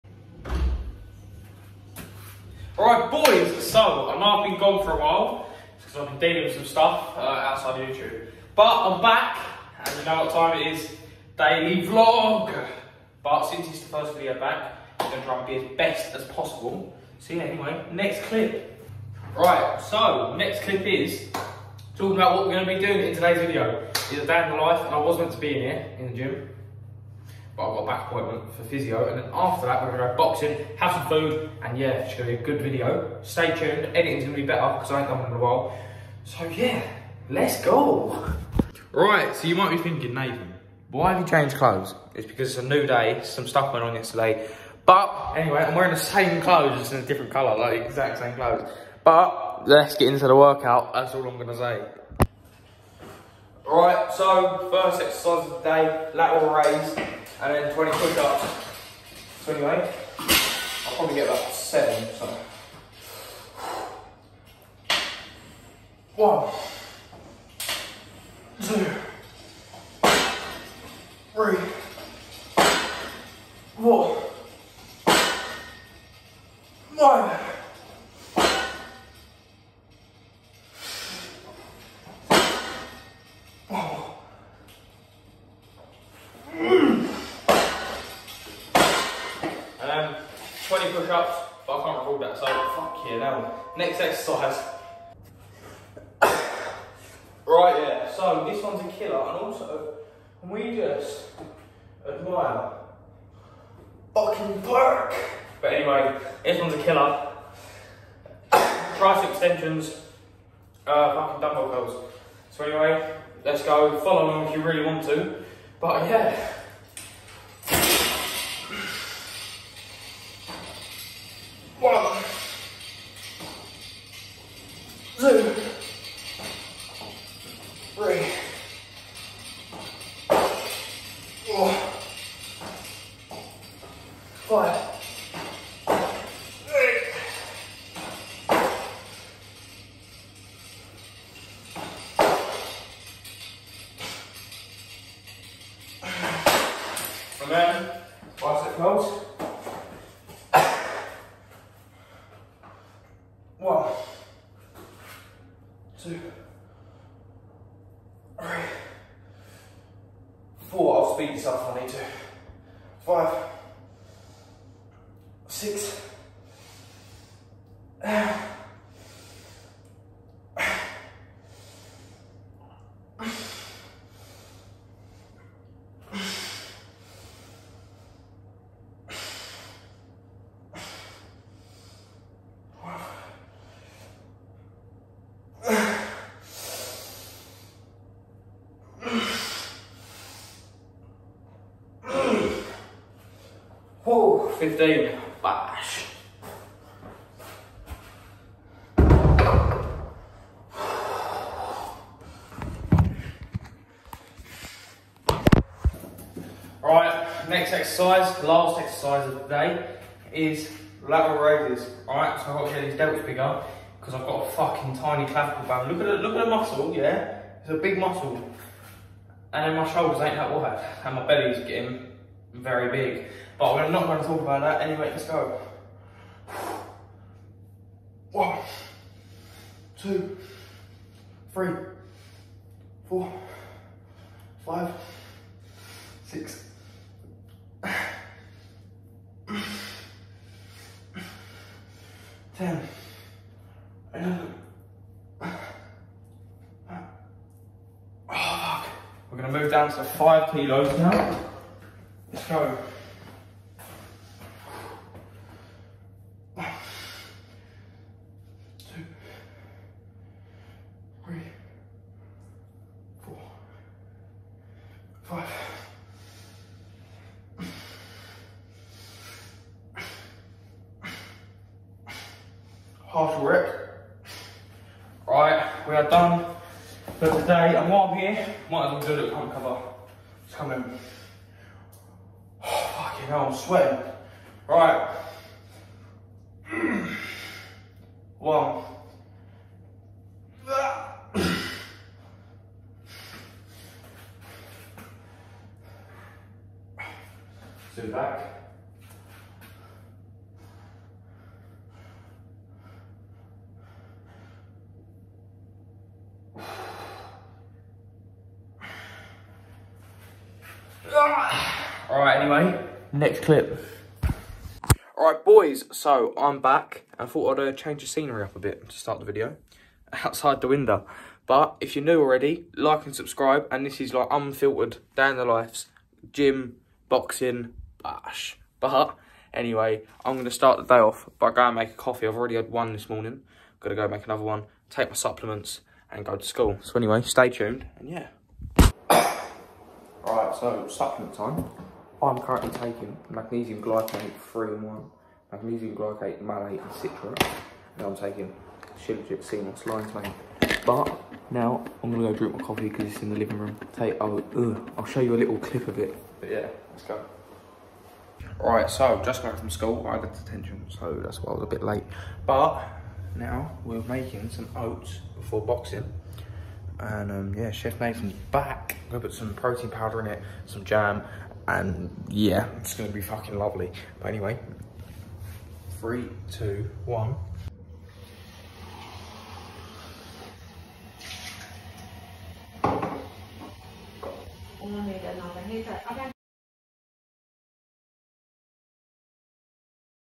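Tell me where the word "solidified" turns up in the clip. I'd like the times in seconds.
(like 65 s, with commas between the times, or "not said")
not said.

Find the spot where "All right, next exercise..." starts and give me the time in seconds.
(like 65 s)
206 s.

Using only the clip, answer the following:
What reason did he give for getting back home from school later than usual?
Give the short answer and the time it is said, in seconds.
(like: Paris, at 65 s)
detention, at 360 s.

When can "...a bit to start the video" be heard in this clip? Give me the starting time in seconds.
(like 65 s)
318 s.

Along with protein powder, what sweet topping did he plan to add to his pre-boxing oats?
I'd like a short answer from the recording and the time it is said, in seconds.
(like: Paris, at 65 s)
jam, at 370 s.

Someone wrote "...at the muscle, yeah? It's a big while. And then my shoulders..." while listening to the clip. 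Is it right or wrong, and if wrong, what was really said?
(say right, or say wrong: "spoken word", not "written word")
wrong: "muscle", not "while".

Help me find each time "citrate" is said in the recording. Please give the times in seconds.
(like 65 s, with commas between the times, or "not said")
346 s.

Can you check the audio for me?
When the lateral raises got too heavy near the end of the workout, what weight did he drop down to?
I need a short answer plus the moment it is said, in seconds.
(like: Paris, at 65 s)
5 kilos, at 250 s.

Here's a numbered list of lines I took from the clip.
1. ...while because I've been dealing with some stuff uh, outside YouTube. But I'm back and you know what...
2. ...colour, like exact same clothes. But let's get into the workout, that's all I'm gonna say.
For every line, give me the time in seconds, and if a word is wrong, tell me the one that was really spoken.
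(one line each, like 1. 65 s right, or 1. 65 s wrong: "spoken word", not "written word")
1. 4 s right
2. 47 s right.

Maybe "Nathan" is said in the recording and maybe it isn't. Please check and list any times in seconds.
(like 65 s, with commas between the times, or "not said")
40 s, 367 s.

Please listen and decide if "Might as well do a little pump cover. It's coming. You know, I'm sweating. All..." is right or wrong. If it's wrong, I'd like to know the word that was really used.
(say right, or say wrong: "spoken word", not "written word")
right.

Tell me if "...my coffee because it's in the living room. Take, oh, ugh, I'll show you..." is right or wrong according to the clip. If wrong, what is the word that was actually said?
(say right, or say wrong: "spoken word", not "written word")
right.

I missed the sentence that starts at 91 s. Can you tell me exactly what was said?
push-ups, but I can't record that, so fuck yeah now.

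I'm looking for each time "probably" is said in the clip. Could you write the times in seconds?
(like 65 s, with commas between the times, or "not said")
60 s.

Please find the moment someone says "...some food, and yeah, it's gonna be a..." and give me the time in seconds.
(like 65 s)
30 s.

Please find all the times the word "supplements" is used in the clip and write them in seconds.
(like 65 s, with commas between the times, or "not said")
335 s, 340 s.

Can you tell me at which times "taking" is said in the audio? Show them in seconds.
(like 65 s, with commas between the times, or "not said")
342 s, 348 s.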